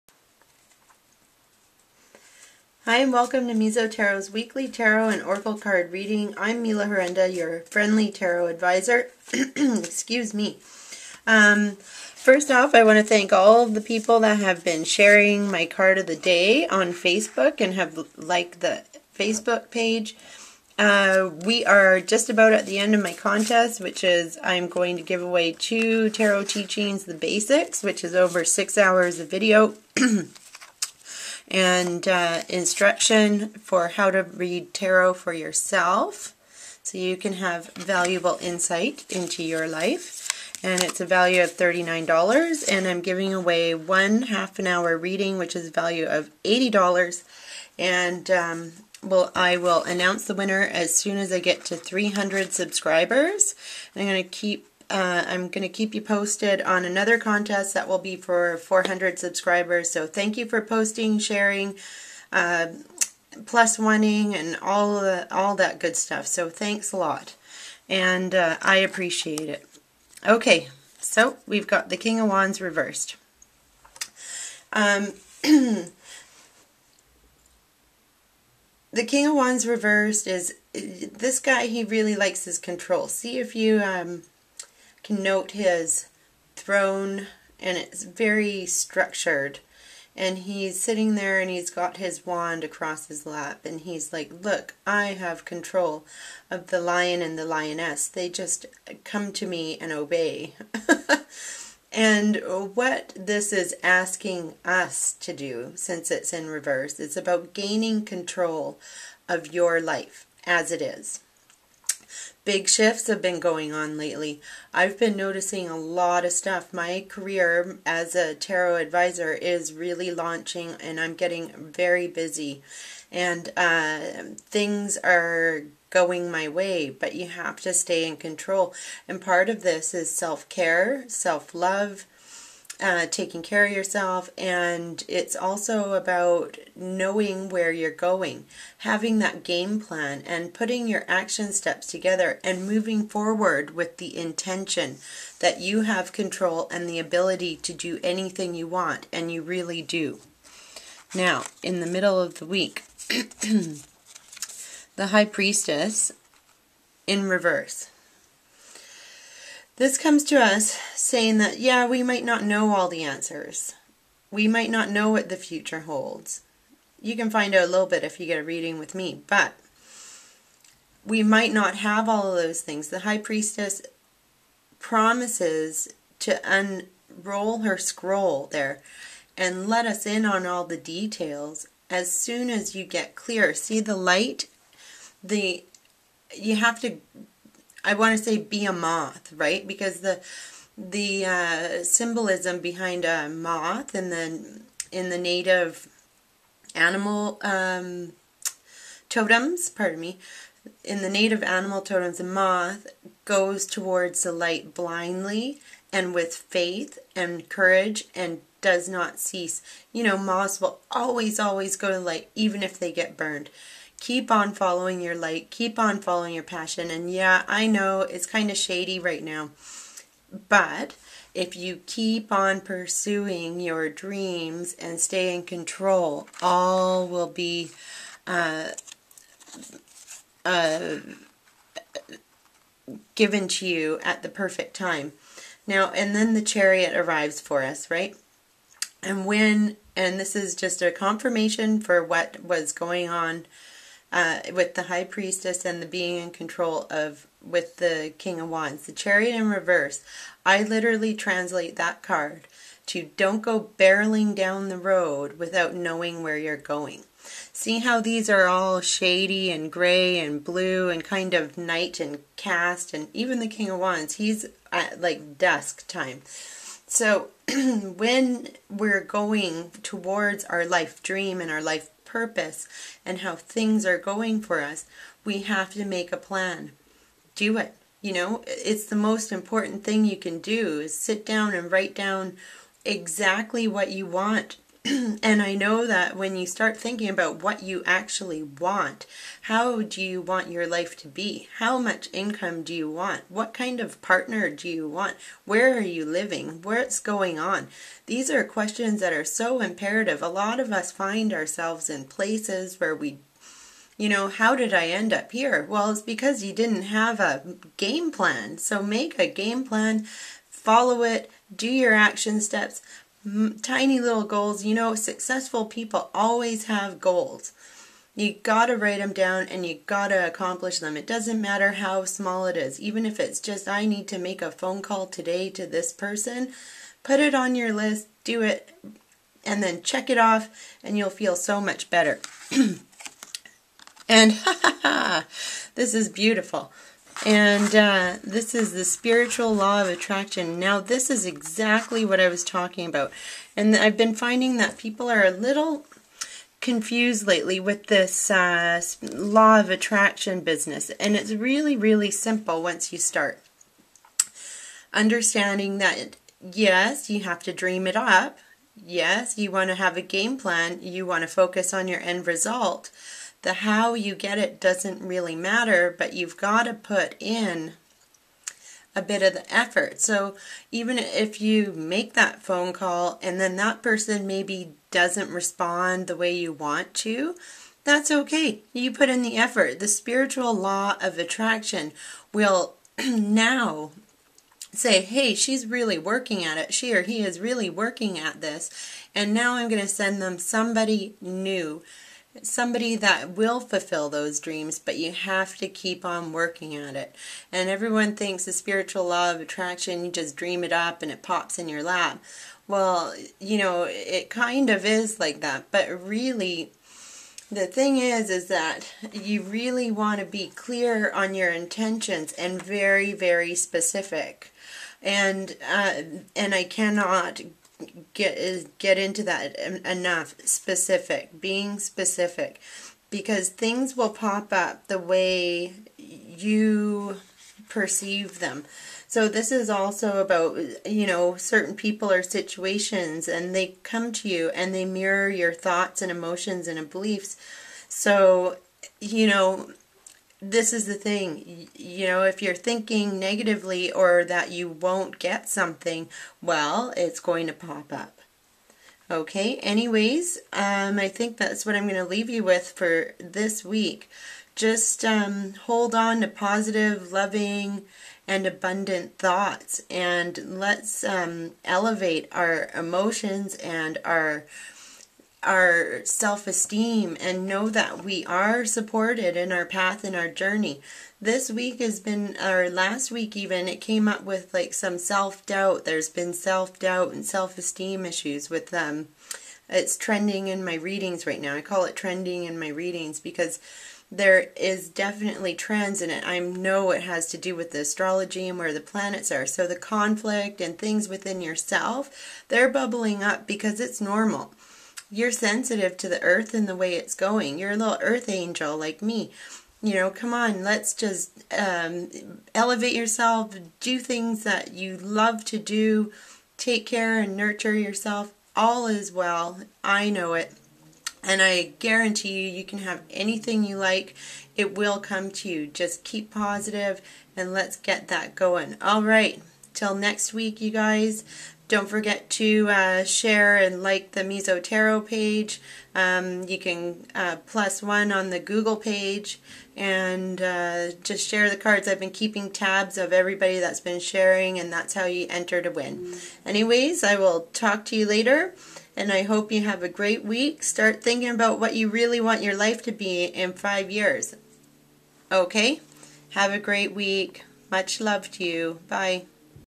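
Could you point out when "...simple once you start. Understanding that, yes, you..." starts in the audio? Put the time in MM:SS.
05:52.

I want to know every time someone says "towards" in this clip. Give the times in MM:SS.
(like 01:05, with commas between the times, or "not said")
03:23, 04:29.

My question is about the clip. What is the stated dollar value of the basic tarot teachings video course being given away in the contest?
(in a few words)
$39.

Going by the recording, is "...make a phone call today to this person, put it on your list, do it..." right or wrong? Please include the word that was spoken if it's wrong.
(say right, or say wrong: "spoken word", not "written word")
right.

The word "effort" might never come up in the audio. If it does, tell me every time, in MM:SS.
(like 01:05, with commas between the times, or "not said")
06:09, 06:19.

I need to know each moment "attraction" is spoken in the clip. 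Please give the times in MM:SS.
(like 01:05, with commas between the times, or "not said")
05:39, 05:49, 06:21, 06:39.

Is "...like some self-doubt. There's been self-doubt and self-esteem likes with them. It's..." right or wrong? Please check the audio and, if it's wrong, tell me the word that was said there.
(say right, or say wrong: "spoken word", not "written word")
wrong: "issues", not "likes".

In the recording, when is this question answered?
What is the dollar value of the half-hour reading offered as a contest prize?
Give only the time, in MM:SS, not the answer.
00:46.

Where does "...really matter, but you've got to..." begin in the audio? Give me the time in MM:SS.
06:05.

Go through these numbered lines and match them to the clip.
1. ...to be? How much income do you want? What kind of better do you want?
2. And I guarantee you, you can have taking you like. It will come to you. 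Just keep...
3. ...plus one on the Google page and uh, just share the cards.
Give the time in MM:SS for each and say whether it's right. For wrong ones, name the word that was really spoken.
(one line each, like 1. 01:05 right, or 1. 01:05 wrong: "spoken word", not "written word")
1. 04:50 wrong: "partner", not "better"
2. 08:31 wrong: "anything", not "taking"
3. 08:47 right.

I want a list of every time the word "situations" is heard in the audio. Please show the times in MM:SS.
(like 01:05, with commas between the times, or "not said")
07:12.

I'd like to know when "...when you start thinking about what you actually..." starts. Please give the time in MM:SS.
04:46.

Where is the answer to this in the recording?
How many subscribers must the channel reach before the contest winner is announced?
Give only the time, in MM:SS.
00:51.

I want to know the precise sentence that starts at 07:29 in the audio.
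Okay, anyways, um, I think that's what I'm going to leave you with for this week.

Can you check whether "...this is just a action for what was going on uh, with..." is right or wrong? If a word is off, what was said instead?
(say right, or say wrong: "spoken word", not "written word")
wrong: "confirmation", not "action".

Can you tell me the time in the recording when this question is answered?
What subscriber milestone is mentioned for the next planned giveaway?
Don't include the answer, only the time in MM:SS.
00:58.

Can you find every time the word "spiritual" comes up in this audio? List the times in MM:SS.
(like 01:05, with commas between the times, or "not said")
05:38, 06:19, 06:38.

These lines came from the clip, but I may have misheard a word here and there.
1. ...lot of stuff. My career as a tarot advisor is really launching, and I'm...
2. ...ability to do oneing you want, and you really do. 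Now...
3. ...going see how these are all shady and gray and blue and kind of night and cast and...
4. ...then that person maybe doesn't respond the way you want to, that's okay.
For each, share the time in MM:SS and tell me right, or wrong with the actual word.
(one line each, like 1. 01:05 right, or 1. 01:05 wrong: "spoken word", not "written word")
1. 01:55 right
2. 02:26 wrong: "anything", not "oneing"
3. 04:16 right
4. 06:13 right.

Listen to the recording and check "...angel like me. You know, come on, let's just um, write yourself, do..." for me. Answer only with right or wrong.
wrong.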